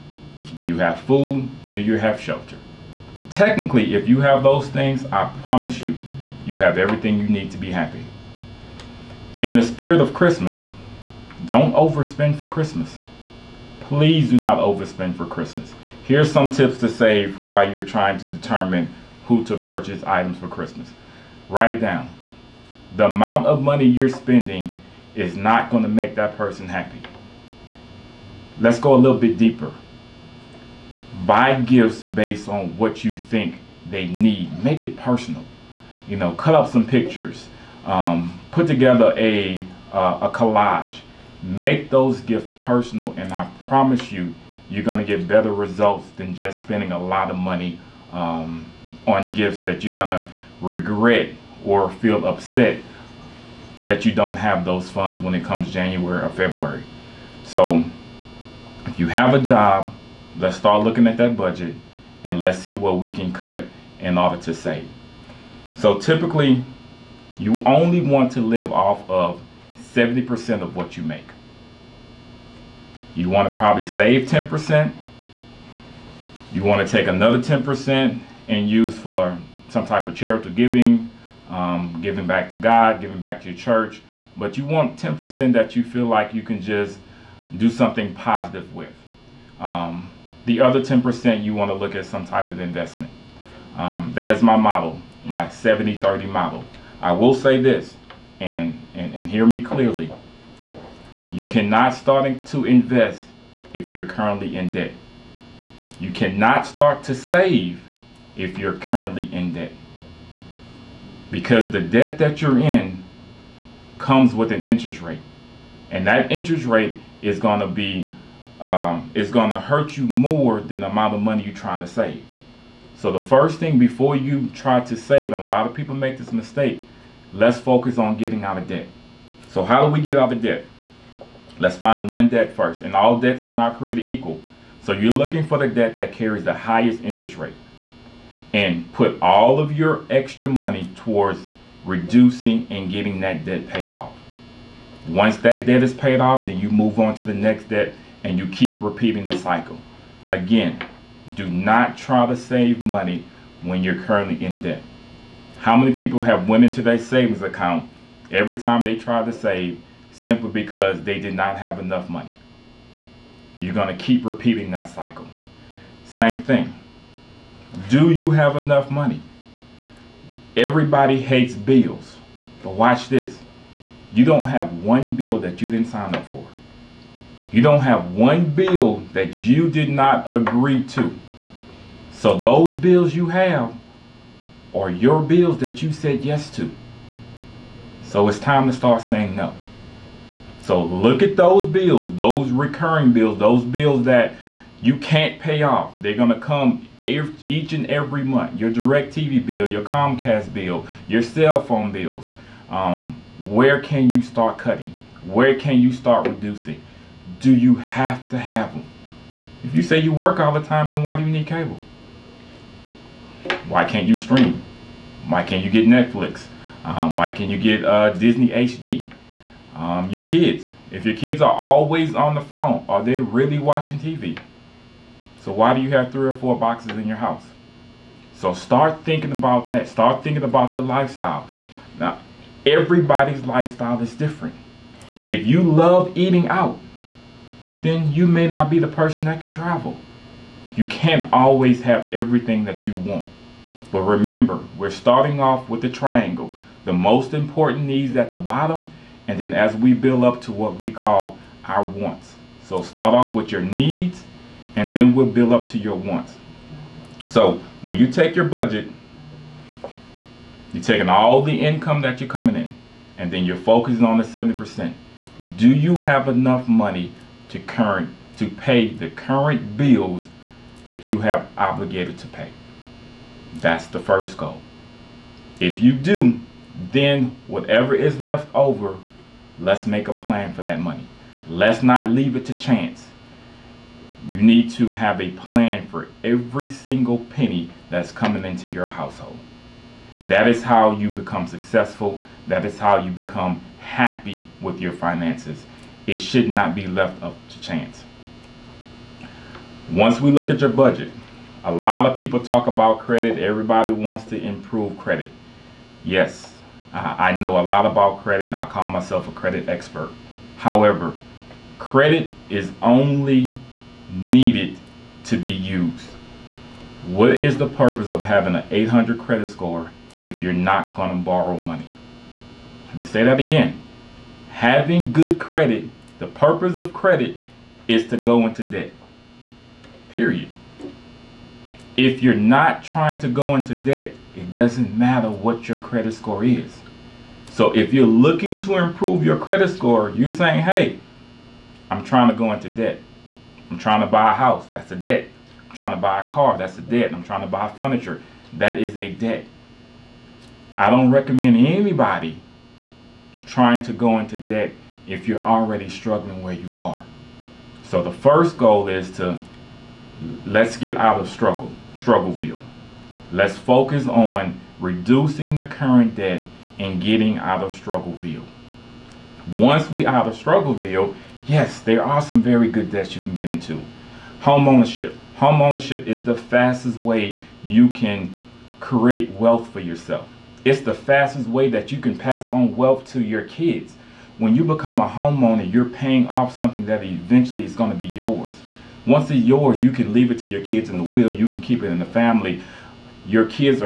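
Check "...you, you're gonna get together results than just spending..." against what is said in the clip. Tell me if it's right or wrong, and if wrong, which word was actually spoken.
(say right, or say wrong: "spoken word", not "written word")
wrong: "better", not "together".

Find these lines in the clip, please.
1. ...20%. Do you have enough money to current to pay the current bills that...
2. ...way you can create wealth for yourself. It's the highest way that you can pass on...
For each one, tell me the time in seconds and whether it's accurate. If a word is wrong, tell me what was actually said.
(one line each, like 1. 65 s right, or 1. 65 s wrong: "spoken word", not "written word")
1. 264 s wrong: "70", not "20"
2. 376 s wrong: "fastest", not "highest".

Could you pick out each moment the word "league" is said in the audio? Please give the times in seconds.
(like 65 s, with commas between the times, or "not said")
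not said.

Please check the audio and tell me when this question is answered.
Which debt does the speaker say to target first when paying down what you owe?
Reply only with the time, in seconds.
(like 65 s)
136 s.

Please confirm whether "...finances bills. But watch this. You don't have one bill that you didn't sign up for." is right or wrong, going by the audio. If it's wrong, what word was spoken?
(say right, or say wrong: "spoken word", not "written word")
wrong: "hates", not "finances".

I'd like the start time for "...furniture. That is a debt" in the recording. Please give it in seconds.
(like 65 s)
347 s.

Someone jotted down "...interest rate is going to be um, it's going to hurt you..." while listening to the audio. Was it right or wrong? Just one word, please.
right.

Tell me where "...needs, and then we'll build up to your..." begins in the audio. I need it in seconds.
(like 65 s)
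253 s.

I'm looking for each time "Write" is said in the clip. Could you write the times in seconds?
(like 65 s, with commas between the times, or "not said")
21 s.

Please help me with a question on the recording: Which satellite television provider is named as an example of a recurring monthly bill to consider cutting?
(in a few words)
Direct TV.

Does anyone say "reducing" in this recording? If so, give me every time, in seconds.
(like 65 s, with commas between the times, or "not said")
141 s, 206 s, 364 s.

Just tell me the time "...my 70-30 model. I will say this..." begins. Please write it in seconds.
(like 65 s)
95 s.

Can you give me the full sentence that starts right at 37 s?
Um, put together a uh, a collage.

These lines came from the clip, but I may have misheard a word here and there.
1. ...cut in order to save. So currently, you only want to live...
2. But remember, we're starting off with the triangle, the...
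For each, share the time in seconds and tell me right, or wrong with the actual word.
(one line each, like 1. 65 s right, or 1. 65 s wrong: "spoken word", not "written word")
1. 63 s wrong: "typically", not "currently"
2. 243 s right.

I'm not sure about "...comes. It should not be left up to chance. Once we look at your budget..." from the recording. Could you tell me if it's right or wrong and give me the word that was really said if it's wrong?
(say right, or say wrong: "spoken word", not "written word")
wrong: "finances", not "comes".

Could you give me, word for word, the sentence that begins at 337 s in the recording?
So if you're looking to improve your credit score, you're saying, hey, I'm trying to go into debt.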